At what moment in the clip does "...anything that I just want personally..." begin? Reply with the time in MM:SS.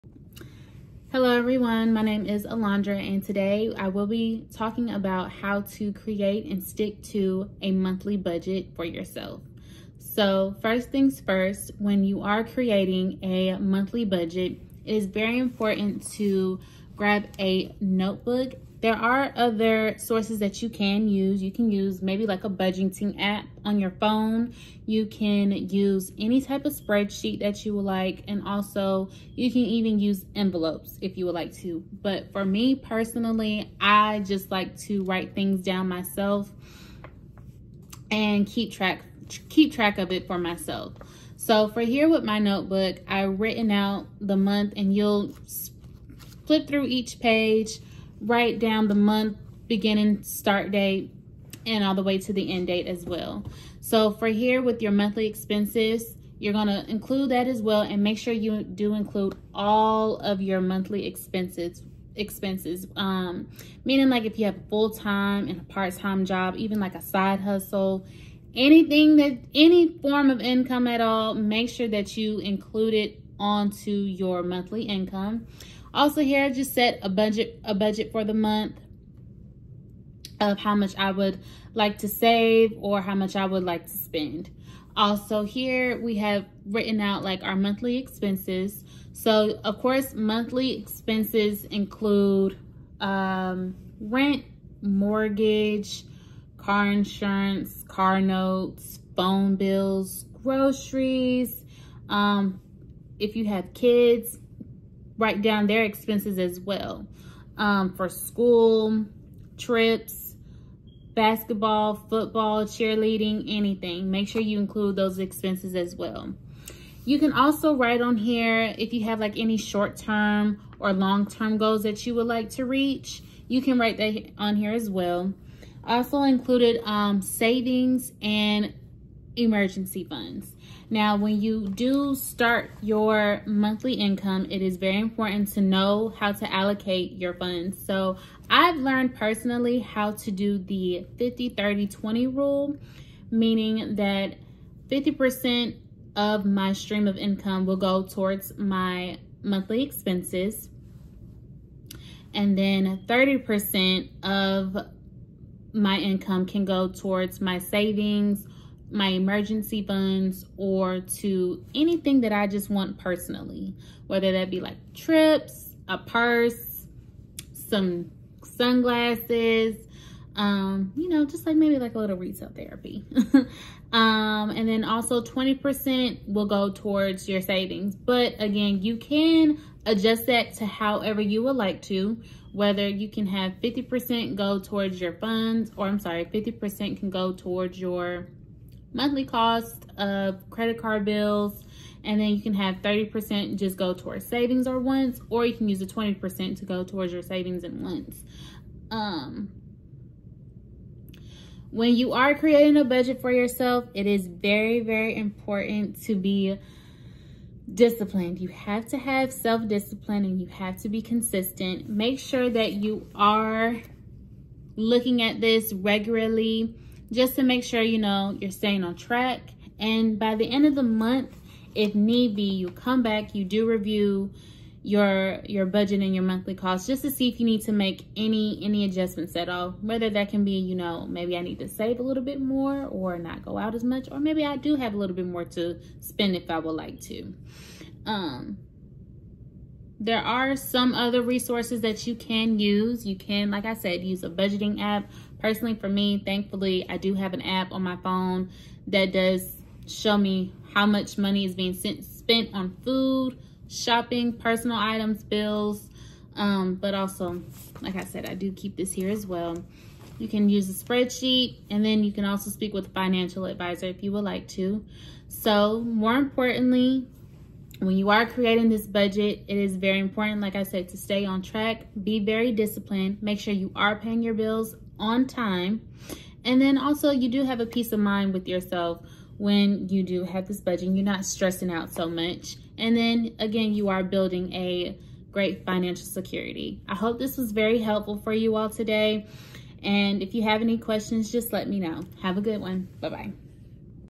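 02:41.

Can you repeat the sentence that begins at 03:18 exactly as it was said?
Um, when you are creating a budget for yourself, it is very, very important to be disciplined.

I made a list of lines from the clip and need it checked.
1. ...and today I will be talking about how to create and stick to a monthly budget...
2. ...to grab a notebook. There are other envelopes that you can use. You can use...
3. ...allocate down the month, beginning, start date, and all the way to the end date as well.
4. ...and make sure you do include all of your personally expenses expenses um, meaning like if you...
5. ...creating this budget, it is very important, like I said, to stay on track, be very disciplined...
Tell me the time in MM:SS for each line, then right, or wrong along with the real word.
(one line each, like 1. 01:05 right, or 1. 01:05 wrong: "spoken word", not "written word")
1. 00:02 right
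2. 00:16 wrong: "sources", not "envelopes"
3. 00:48 wrong: "write", not "allocate"
4. 00:57 wrong: "monthly", not "personally"
5. 04:28 right.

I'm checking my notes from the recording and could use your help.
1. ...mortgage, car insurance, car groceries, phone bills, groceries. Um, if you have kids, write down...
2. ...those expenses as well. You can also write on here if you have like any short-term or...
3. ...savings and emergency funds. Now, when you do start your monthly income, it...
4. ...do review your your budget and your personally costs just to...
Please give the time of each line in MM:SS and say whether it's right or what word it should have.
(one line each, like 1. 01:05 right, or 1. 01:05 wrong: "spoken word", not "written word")
1. 01:34 wrong: "notes", not "groceries"
2. 01:54 right
3. 02:07 right
4. 03:43 wrong: "monthly", not "personally".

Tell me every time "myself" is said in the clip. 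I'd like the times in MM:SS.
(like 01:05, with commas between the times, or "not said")
00:35, 00:40.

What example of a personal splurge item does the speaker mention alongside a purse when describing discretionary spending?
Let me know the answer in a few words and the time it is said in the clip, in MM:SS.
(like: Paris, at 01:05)
Sunglasses, at 02:48.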